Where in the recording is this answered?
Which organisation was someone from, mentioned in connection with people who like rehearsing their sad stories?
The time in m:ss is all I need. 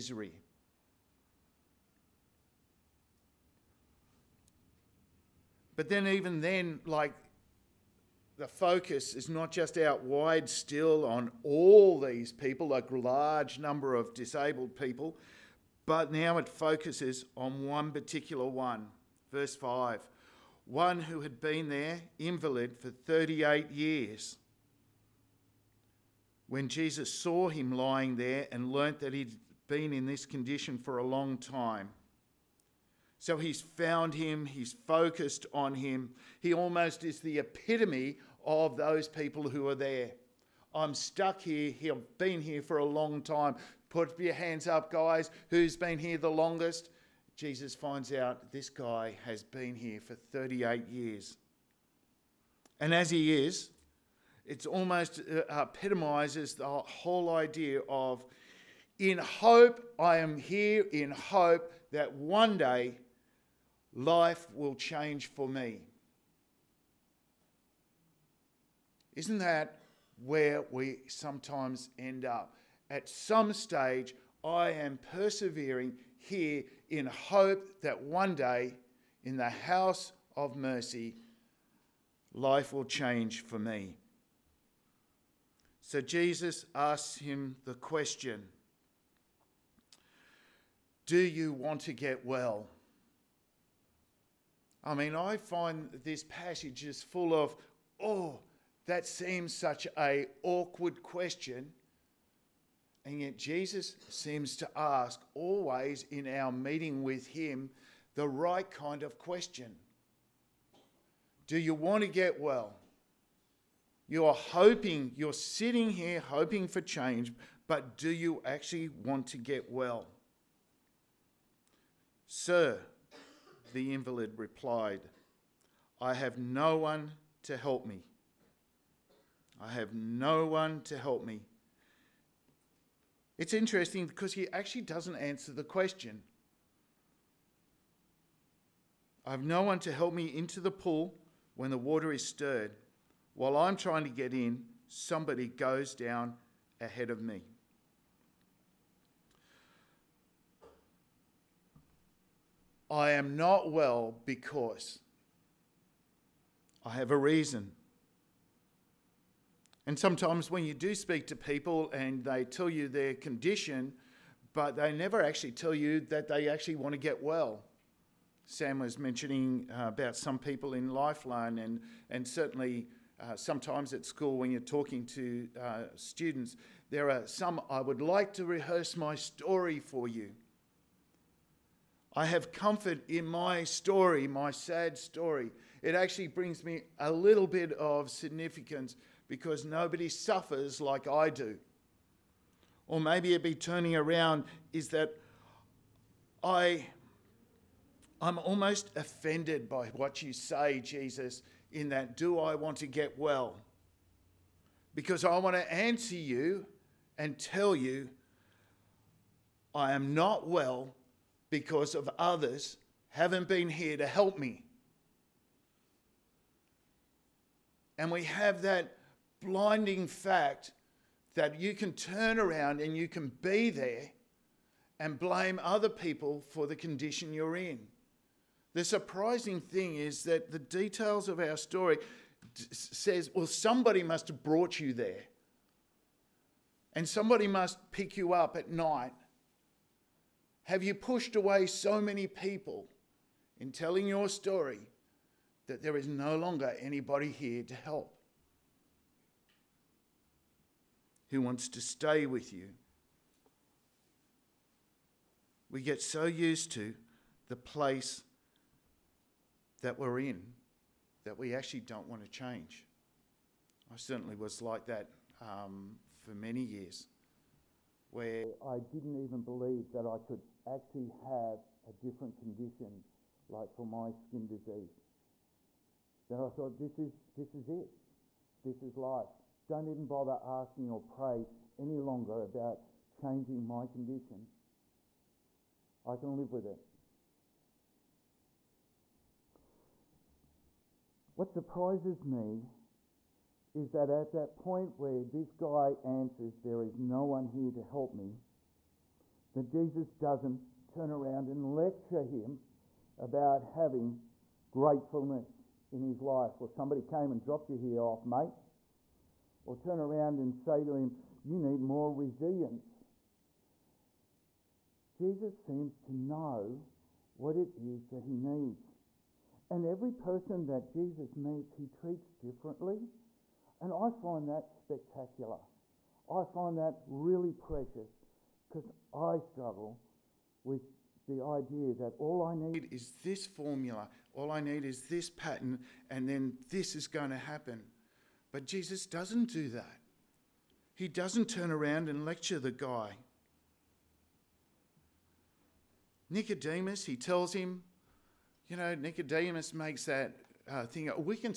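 2:50.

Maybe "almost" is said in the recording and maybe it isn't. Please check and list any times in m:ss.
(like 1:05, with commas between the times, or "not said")
0:36, 0:54, 3:18.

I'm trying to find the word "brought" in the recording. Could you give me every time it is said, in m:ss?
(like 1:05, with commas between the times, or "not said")
3:54.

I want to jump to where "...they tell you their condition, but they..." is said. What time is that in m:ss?
2:42.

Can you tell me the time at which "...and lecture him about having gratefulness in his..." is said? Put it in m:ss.
5:01.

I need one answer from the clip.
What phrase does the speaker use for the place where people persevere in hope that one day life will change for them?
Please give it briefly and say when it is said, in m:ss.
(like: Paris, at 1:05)
house of mercy, at 1:19.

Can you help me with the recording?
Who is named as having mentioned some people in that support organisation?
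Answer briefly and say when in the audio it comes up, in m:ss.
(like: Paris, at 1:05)
Sam, at 2:48.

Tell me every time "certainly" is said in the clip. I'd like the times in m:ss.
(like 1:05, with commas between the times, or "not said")
2:52, 4:23.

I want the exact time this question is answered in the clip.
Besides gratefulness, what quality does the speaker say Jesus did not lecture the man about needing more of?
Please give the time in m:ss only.
5:12.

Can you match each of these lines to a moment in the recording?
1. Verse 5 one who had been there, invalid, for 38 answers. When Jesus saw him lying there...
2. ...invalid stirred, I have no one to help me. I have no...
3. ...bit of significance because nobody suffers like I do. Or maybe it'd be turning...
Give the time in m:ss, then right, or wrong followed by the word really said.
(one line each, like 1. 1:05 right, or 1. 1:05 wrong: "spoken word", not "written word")
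1. 0:19 wrong: "years", not "answers"
2. 2:03 wrong: "replied", not "stirred"
3. 3:07 right.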